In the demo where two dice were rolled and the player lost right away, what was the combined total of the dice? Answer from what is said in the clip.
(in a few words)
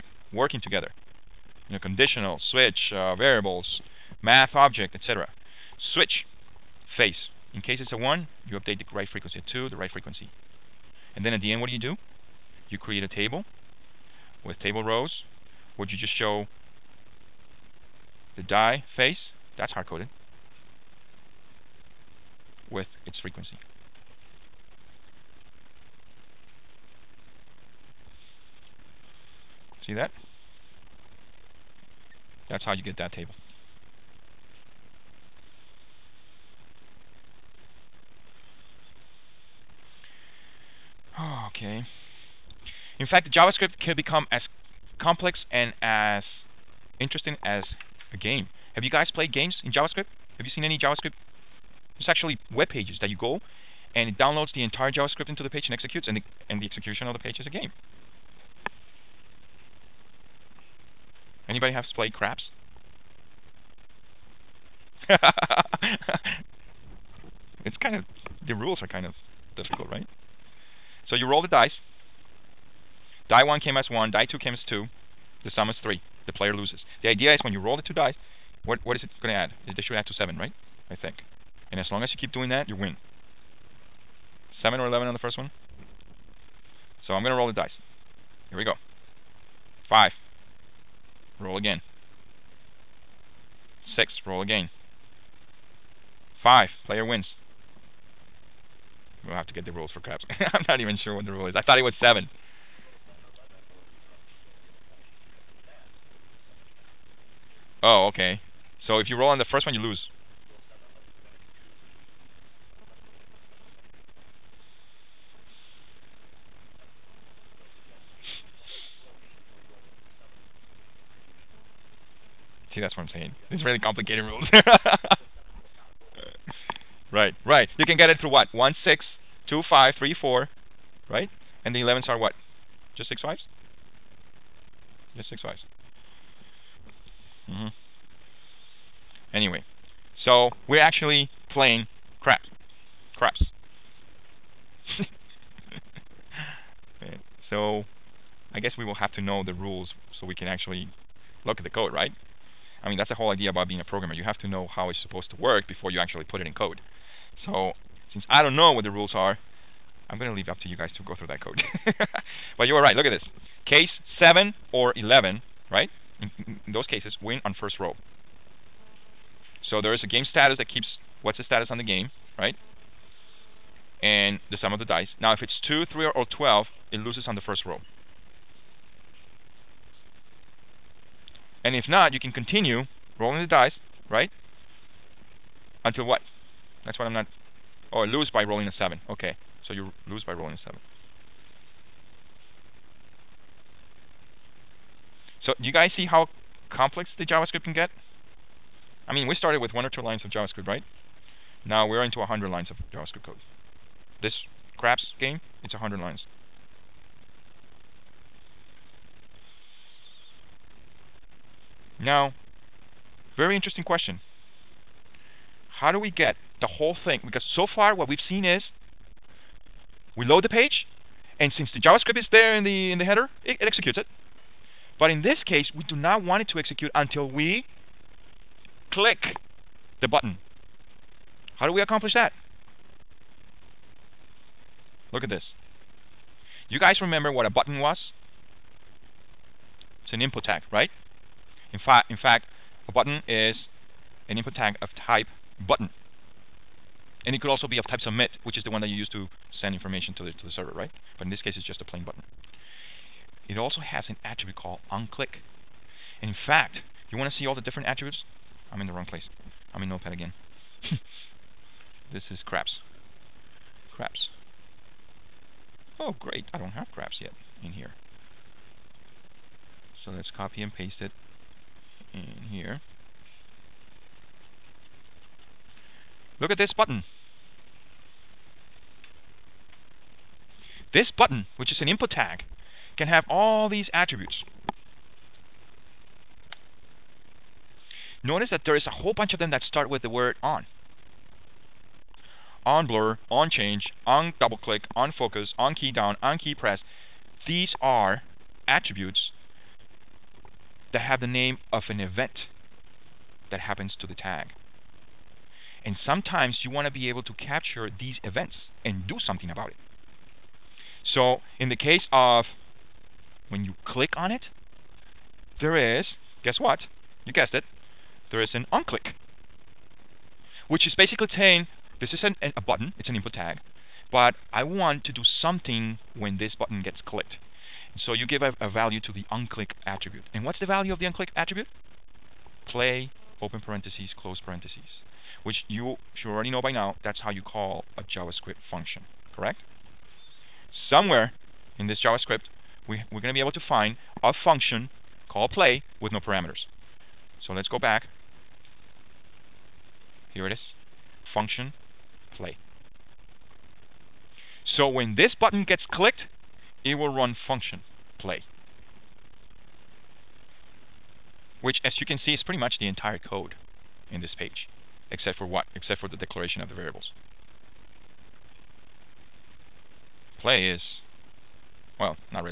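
3.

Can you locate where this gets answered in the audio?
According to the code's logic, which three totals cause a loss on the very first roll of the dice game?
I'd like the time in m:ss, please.
2:55.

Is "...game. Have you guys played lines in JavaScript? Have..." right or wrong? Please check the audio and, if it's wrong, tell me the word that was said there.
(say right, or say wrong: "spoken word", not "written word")
wrong: "games", not "lines".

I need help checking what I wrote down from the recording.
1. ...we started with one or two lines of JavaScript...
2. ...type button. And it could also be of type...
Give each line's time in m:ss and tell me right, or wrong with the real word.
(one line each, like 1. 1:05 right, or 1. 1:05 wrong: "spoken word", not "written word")
1. 3:19 right
2. 4:05 right.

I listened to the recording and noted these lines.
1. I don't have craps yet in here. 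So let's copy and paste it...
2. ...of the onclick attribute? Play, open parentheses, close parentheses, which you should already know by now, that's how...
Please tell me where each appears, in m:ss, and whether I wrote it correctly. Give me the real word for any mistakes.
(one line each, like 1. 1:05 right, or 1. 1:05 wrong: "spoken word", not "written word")
1. 4:26 right
2. 5:30 right.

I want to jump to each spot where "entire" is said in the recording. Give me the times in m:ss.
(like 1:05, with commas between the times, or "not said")
0:54, 6:02.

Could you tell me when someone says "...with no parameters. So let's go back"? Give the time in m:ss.
5:46.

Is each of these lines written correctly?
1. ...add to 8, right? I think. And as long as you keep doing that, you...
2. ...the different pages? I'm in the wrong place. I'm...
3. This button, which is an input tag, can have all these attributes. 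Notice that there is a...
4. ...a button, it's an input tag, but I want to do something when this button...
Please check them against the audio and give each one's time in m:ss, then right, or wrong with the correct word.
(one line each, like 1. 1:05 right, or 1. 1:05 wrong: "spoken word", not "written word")
1. 1:19 wrong: "7", not "8"
2. 4:17 wrong: "attributes", not "pages"
3. 4:40 right
4. 5:22 right.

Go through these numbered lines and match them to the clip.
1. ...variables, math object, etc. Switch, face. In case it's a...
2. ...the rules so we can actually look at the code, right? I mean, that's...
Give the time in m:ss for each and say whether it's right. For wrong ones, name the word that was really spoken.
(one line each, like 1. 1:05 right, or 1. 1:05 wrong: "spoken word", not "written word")
1. 0:03 right
2. 2:29 right.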